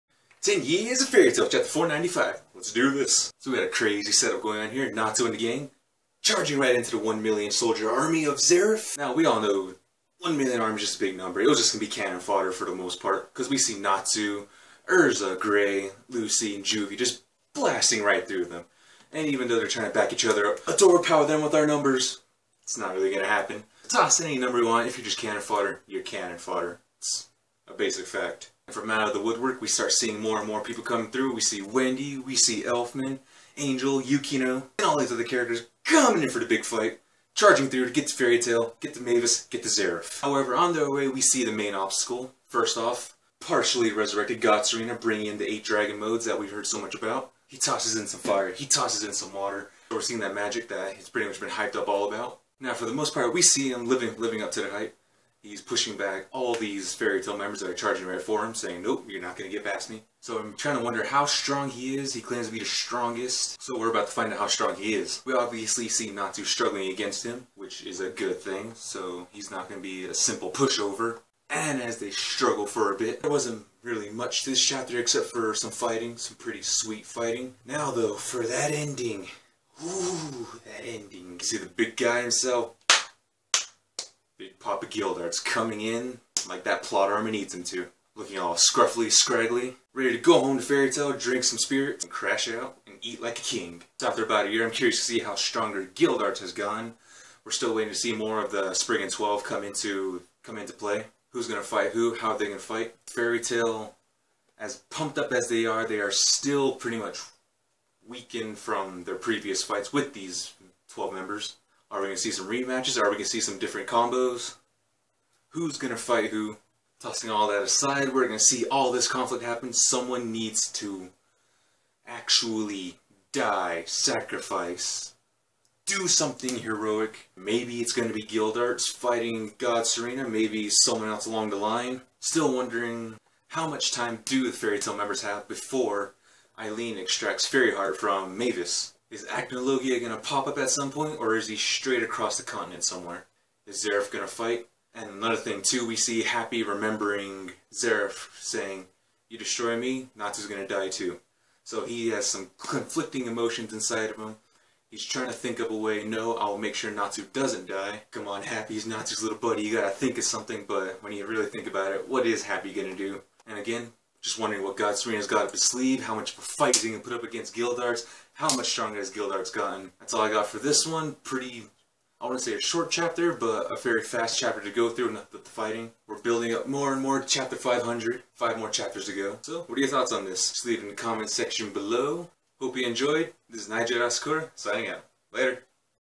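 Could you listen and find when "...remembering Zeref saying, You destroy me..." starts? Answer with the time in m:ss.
2:26.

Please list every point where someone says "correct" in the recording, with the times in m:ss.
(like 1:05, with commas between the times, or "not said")
not said.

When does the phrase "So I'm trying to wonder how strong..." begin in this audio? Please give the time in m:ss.
1:00.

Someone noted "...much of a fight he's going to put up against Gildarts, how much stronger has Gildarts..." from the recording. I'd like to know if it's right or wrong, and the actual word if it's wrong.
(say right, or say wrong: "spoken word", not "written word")
right.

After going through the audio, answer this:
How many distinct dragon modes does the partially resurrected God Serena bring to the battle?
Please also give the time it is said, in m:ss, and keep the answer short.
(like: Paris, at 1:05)
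8, at 0:45.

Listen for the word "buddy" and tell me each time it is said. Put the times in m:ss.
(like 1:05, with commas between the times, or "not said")
2:39.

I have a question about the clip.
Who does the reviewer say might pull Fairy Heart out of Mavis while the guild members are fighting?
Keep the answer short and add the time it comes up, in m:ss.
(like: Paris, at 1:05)
Eileen, at 2:16.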